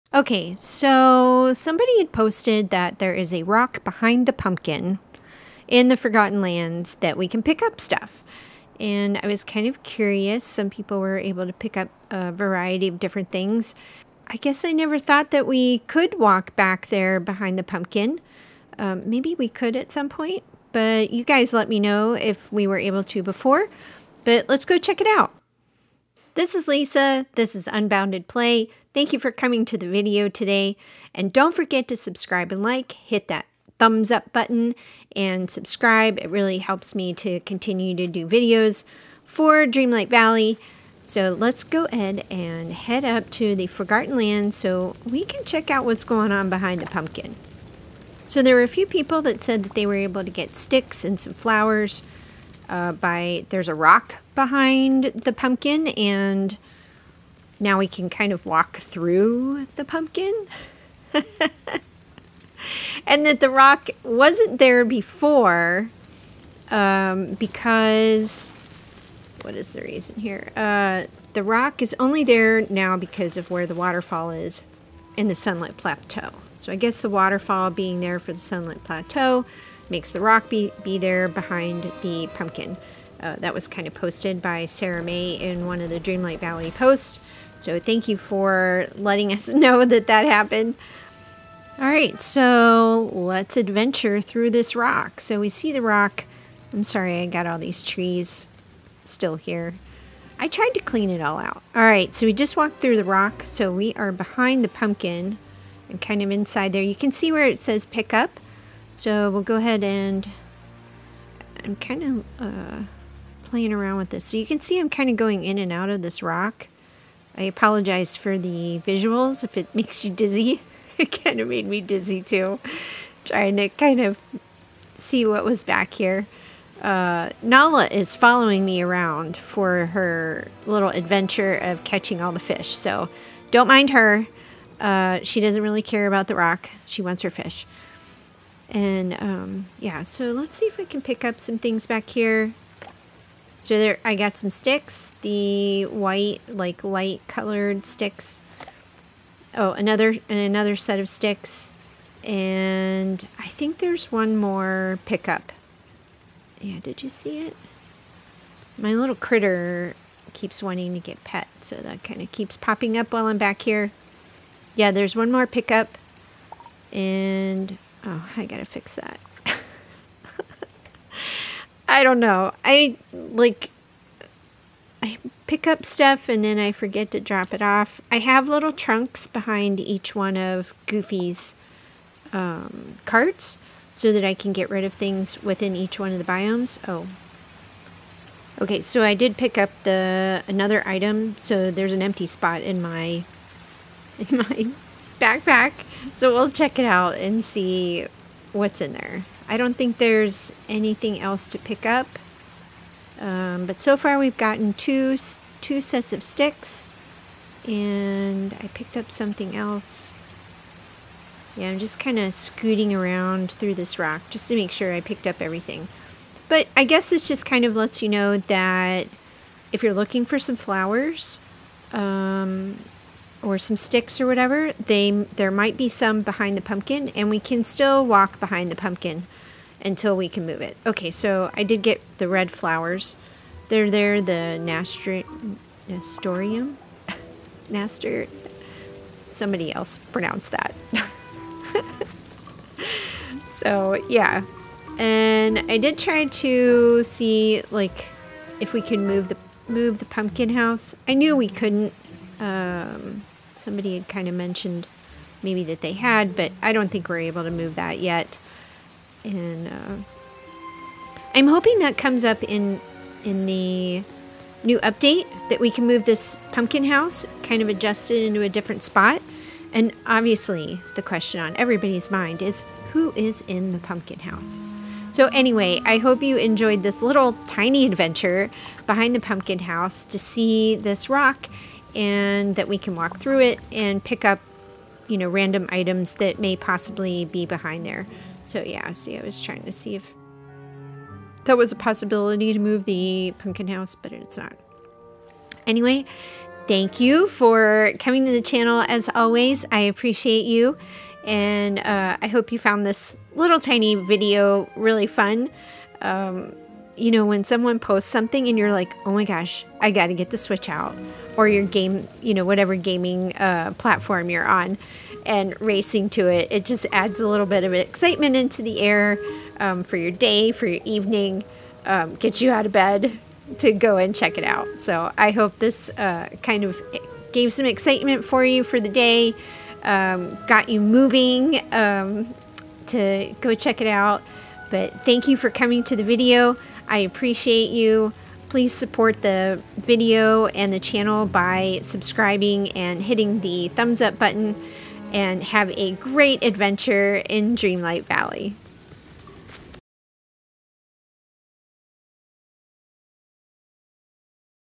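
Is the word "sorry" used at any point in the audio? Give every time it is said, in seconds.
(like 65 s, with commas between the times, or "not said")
96 s.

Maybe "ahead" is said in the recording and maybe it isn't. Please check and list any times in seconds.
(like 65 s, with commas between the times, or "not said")
41 s, 109 s.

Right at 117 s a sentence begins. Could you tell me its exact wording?
I apologize for the visuals if it makes you dizzy.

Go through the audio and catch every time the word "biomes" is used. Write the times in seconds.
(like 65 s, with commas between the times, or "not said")
186 s.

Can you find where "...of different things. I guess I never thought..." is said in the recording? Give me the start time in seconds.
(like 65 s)
12 s.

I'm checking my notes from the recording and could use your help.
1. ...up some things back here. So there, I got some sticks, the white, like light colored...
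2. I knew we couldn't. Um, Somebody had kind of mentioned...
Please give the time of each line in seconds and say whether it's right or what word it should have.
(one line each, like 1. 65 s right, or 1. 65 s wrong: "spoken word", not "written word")
1. 141 s right
2. 251 s right.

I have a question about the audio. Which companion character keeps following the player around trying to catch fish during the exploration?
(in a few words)
Nala.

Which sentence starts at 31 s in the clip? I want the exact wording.
And don't forget to subscribe and like, hit that thumbs up button and subscribe.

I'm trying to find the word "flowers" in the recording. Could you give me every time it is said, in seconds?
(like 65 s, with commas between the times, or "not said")
51 s, 220 s, 232 s.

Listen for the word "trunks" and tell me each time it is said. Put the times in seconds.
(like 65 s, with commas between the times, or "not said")
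178 s.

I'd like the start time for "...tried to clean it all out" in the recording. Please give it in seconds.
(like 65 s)
100 s.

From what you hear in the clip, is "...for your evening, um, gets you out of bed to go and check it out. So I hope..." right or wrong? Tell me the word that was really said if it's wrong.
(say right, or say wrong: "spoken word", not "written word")
right.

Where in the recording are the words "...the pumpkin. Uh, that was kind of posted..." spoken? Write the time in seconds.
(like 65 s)
82 s.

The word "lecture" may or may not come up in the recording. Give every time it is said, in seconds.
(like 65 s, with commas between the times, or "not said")
not said.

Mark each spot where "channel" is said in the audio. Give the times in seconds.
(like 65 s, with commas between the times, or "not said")
298 s, 340 s.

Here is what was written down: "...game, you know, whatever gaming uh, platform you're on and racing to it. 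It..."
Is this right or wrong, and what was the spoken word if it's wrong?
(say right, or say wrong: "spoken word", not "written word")
right.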